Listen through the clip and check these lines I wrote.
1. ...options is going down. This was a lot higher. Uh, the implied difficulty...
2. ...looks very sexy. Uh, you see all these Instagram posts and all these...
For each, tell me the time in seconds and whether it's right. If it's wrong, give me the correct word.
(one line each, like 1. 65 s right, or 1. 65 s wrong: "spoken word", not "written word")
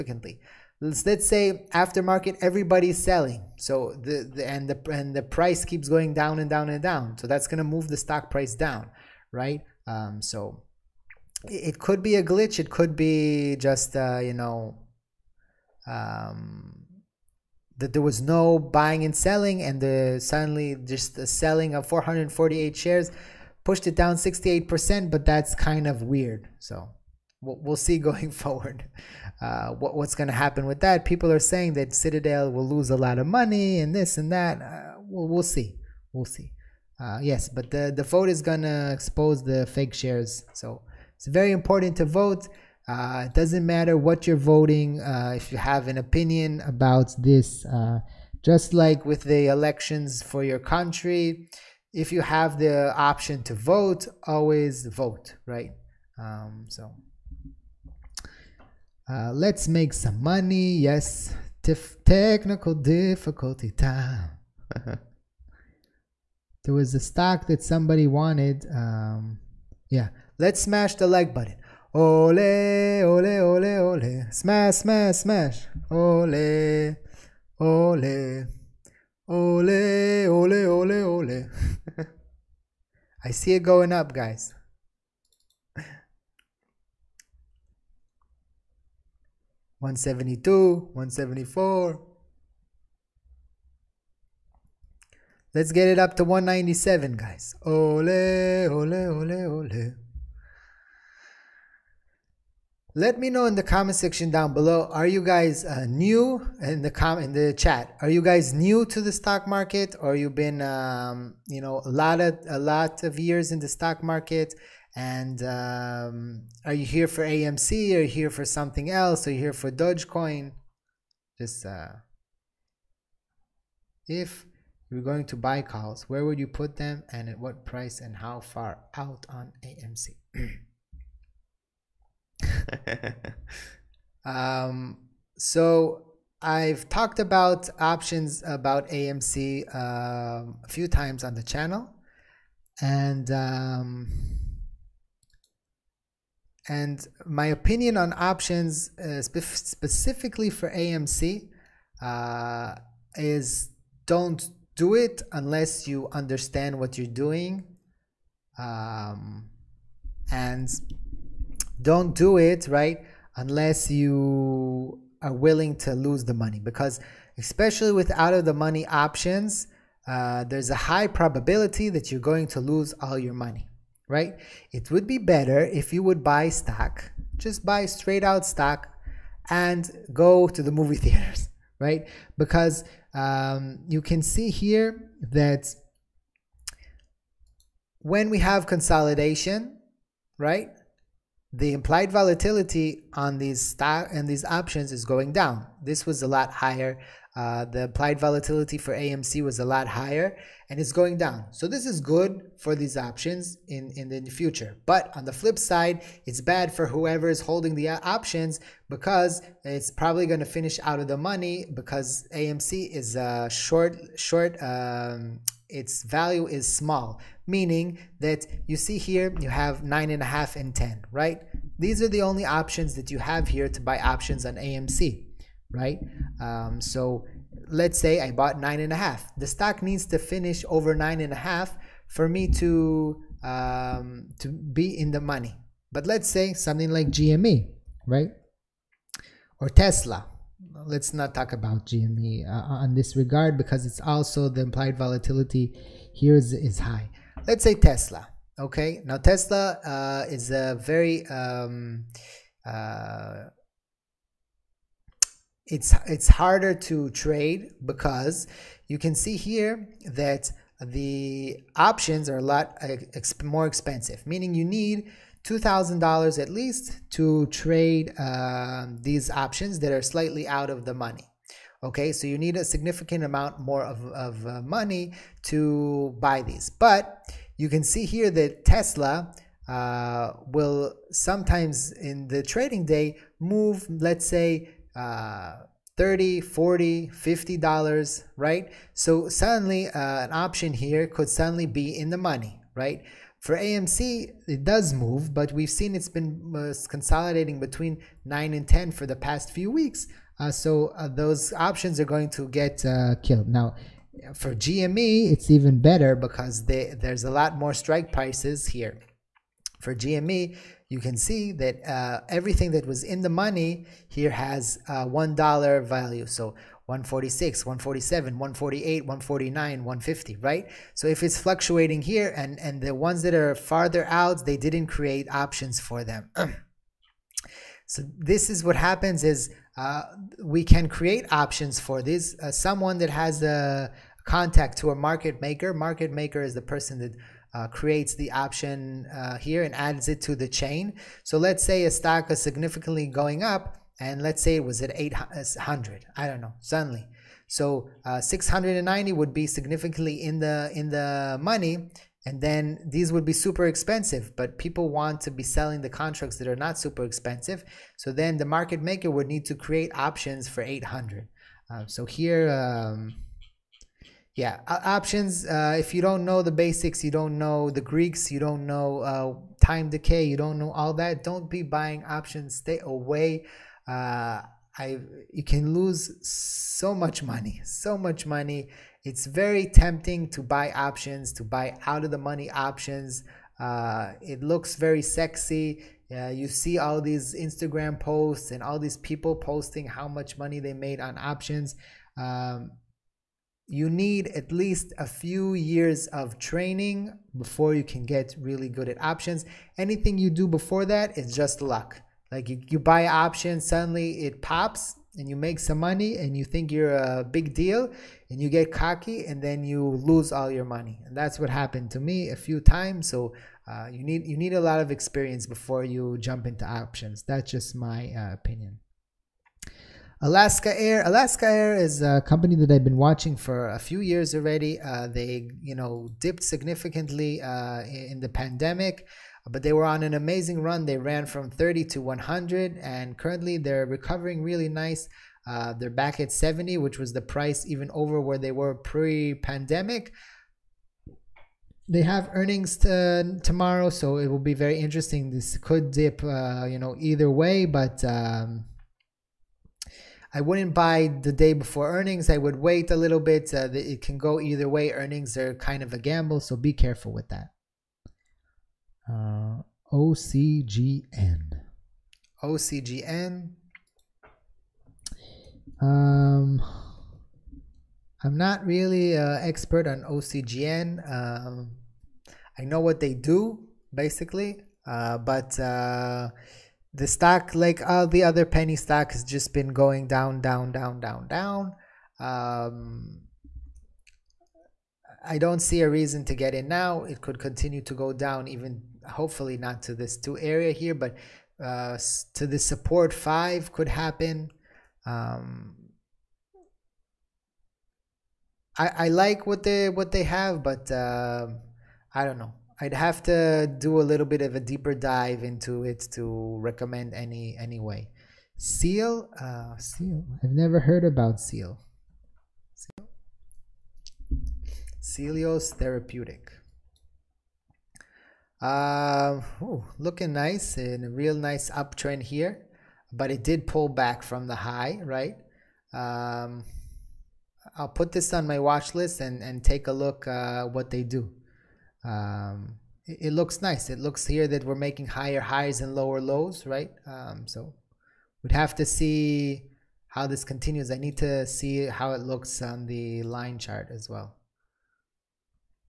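1. 194 s wrong: "volatility", not "difficulty"
2. 384 s right.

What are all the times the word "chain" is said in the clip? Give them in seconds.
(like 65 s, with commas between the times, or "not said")
340 s.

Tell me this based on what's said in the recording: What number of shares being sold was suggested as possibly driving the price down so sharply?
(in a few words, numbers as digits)
448.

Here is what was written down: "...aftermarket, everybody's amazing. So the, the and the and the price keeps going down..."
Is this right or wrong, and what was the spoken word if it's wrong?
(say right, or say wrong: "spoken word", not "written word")
wrong: "selling", not "amazing".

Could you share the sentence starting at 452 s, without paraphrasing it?
I would wait a little bit.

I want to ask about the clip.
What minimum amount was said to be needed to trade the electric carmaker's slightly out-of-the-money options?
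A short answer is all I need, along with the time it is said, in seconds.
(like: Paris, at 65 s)
$2,000, at 265 s.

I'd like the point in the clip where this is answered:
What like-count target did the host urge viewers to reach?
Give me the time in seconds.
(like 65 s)
96 s.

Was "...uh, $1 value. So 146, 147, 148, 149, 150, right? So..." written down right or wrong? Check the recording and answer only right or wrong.
right.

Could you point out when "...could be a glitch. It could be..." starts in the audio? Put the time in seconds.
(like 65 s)
11 s.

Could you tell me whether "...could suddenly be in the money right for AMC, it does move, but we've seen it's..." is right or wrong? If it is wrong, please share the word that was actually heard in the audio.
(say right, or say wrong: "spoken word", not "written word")
right.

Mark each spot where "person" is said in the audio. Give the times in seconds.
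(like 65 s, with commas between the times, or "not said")
336 s.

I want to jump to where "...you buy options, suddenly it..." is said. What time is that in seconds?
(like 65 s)
402 s.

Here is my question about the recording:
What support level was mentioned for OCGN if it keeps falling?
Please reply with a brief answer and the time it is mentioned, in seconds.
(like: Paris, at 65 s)
5, at 493 s.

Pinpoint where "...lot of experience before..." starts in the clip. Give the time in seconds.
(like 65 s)
414 s.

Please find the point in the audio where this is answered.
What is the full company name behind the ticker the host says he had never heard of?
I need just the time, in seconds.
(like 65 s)
515 s.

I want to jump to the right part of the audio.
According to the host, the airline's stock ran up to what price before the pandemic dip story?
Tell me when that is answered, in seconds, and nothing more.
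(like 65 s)
432 s.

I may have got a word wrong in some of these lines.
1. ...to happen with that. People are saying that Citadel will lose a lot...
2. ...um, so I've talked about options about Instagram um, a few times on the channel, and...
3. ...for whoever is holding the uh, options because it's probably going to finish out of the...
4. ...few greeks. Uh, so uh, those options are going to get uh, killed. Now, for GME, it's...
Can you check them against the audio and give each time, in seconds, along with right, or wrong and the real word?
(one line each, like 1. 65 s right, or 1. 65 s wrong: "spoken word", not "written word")
1. 30 s right
2. 134 s wrong: "AMC", not "Instagram"
3. 206 s right
4. 299 s wrong: "weeks", not "greeks".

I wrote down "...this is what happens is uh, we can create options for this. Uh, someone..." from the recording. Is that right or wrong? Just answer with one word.
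right.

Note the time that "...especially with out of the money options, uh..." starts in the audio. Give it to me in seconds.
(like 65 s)
167 s.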